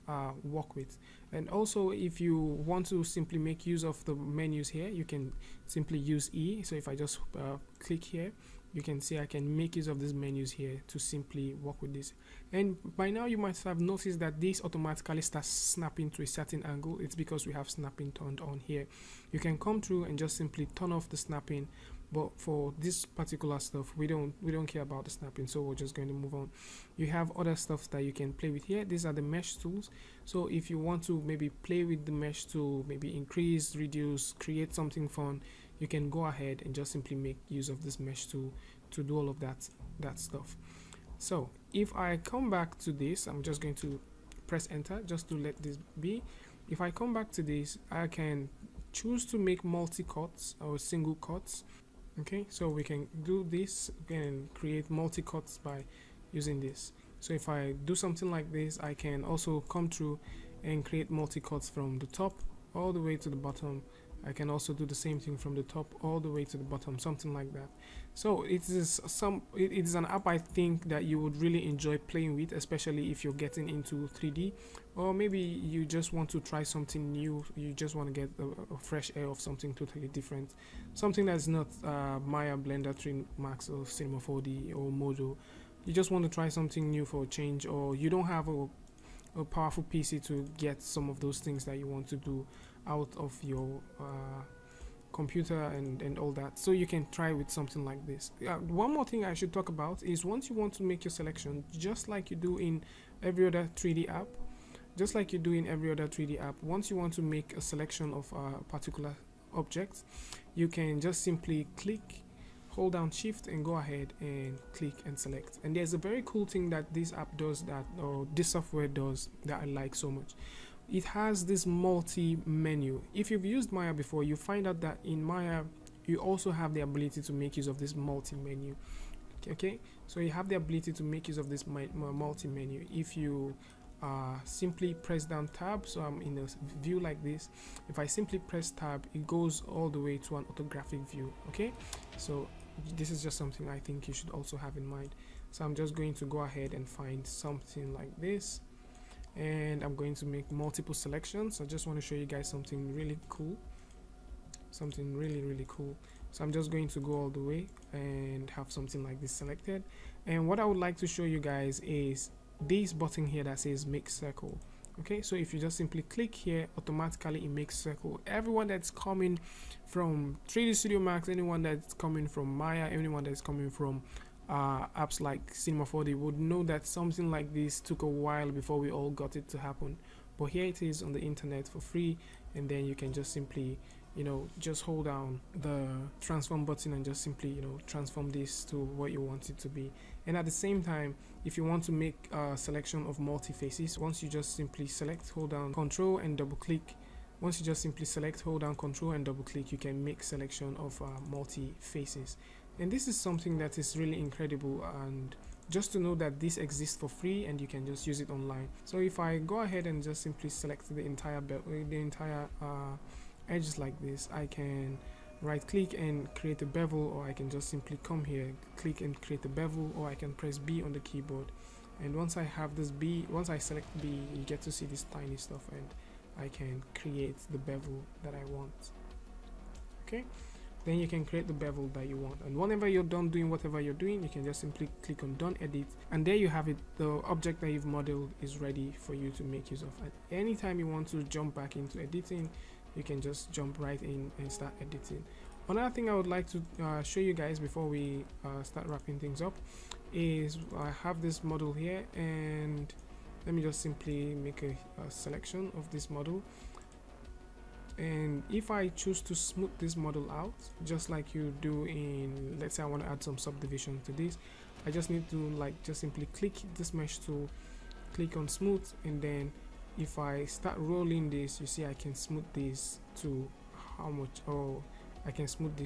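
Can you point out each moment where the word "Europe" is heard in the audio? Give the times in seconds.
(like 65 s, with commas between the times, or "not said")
not said.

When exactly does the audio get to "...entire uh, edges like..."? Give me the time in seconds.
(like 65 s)
211 s.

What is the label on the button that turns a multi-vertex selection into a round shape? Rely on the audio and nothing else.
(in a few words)
Make circle.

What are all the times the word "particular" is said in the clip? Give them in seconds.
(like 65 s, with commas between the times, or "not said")
23 s, 108 s.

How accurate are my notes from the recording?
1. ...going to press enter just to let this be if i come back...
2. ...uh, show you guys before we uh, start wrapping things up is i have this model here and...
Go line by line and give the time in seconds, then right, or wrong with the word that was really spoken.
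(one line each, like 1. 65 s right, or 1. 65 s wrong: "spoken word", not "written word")
1. 43 s right
2. 246 s right.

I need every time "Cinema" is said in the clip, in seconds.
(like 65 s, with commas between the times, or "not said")
83 s, 175 s.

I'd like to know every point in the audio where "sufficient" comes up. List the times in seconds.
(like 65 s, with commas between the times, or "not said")
not said.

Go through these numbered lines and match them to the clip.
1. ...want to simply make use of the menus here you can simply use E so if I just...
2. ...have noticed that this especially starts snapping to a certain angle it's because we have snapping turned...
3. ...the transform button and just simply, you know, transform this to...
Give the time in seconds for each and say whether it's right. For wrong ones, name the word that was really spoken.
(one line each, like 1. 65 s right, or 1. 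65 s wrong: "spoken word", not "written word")
1. 2 s right
2. 13 s wrong: "automatically", not "especially"
3. 185 s right.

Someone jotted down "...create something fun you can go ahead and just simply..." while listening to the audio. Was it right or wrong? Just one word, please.
right.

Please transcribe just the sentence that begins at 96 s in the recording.
So you can try with something like this.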